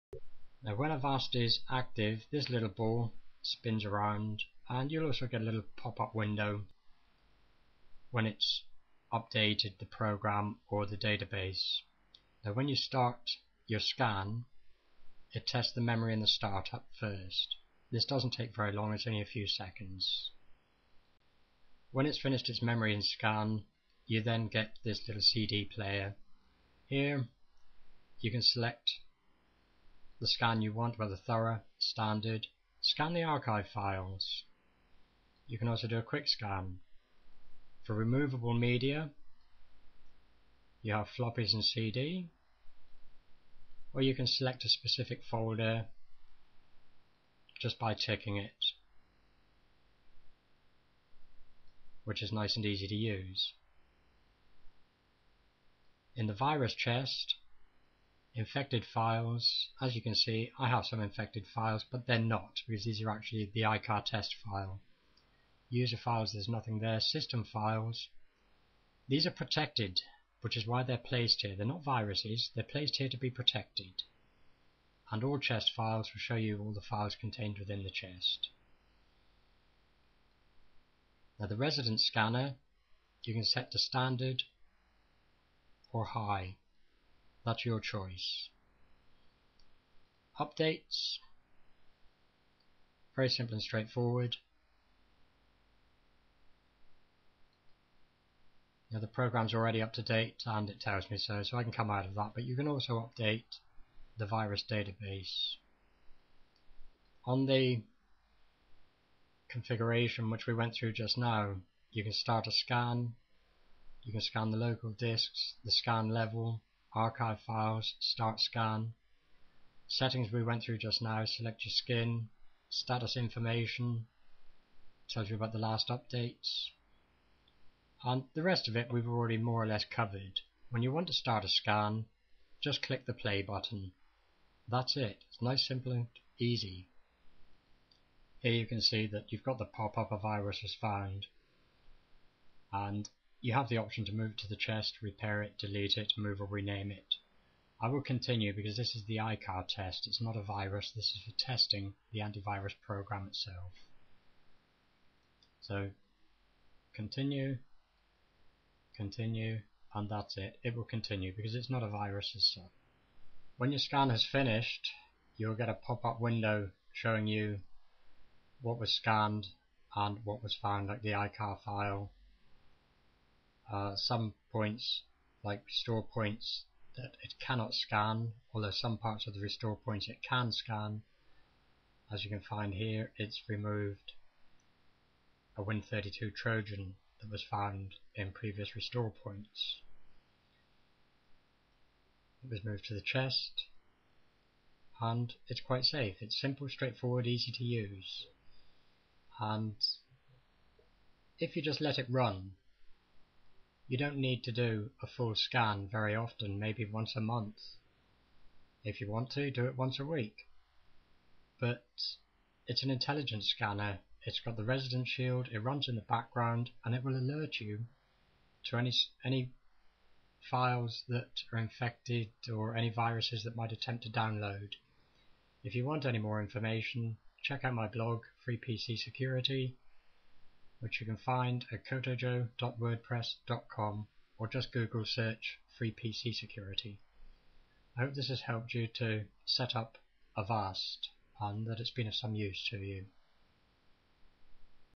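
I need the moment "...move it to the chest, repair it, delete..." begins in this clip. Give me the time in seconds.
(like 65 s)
144 s.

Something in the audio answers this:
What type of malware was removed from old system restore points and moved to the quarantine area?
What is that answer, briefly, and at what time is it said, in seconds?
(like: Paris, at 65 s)
Win32 Trojan, at 185 s.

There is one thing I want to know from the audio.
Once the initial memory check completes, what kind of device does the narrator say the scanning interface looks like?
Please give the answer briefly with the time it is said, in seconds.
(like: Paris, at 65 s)
CD player, at 25 s.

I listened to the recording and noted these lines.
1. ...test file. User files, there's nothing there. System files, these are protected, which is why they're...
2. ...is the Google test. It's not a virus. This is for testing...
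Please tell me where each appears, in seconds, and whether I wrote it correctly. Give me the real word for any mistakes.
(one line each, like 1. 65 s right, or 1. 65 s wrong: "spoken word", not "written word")
1. 64 s right
2. 148 s wrong: "EICAR", not "Google".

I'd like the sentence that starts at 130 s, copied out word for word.
When you want to start a scan, just click the play button.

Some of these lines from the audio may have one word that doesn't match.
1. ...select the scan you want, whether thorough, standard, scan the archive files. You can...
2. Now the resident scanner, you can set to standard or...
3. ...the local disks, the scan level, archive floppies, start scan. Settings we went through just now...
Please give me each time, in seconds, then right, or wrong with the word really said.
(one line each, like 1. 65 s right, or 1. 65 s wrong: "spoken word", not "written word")
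1. 28 s right
2. 81 s right
3. 114 s wrong: "files", not "floppies".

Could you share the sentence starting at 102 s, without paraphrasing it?
But you can also update the virus database.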